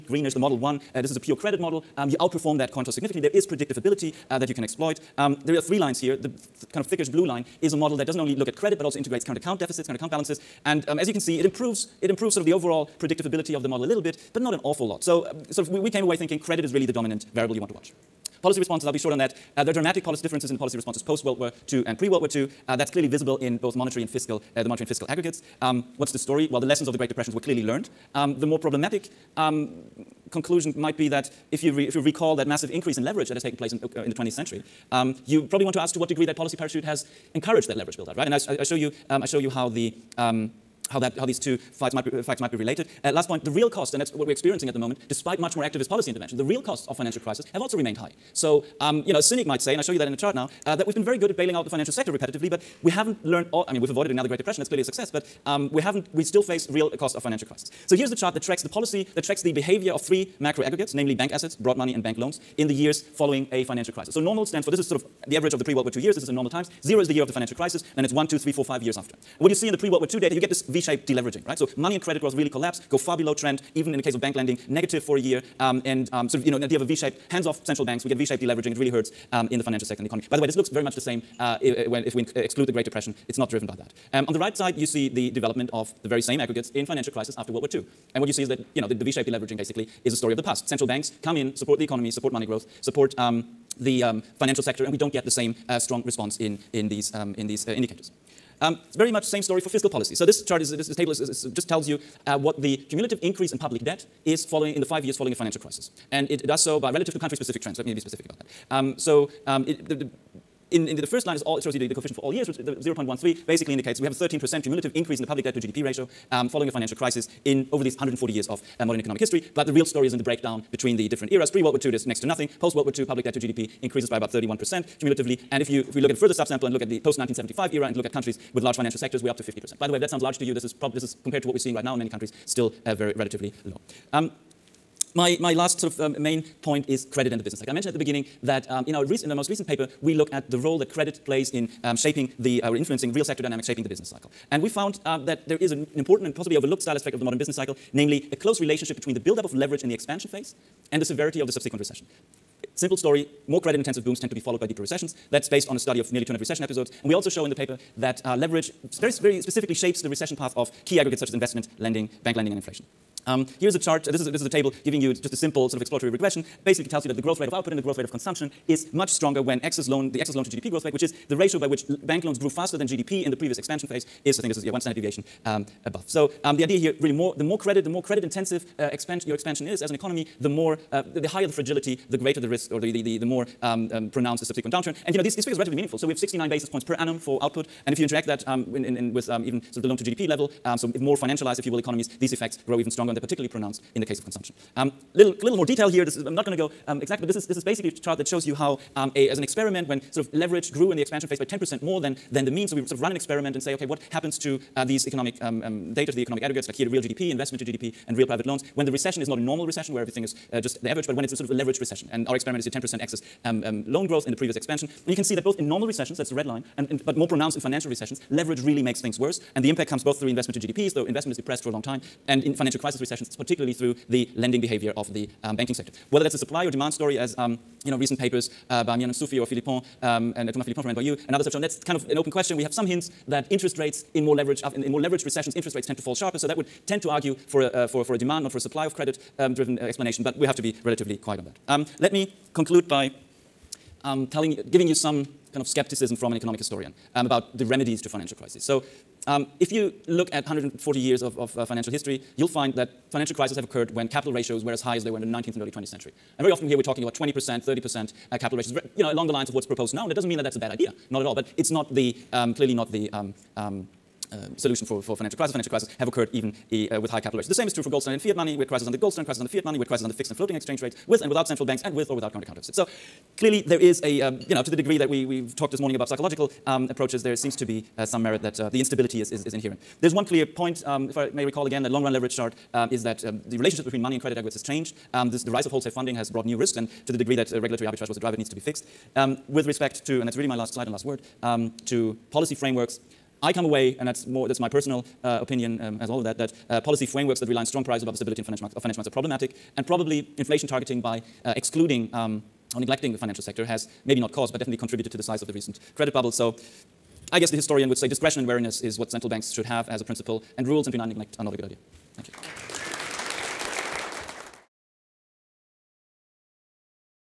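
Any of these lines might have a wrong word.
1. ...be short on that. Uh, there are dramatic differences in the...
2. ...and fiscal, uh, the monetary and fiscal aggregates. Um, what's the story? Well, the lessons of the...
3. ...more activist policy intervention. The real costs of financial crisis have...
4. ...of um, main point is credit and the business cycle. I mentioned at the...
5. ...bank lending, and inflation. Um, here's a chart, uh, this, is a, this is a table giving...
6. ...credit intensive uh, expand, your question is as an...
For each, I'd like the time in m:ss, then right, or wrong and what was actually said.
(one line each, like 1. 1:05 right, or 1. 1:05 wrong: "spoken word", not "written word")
1. 0:18 right
2. 0:24 right
3. 0:45 right
4. 2:15 right
5. 2:42 right
6. 2:58 wrong: "expansion", not "question".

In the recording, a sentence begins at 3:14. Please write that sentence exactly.
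Um, little, little more detail here.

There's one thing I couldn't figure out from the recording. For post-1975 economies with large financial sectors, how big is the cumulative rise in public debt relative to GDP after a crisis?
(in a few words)
50%.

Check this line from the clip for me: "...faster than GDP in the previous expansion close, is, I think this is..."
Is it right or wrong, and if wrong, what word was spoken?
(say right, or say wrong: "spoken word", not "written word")
wrong: "phase", not "close".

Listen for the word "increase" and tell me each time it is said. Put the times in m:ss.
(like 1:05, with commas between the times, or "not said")
0:32, 1:43, 1:54, 2:03.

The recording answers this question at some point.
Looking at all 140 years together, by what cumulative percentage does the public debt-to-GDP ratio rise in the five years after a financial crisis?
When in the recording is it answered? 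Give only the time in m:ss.
1:54.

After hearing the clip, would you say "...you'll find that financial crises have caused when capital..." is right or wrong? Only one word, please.
wrong.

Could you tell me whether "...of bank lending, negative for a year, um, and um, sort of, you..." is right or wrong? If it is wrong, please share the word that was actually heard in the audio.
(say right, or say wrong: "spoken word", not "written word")
right.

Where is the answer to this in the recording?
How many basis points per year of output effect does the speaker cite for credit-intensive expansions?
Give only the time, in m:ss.
3:06.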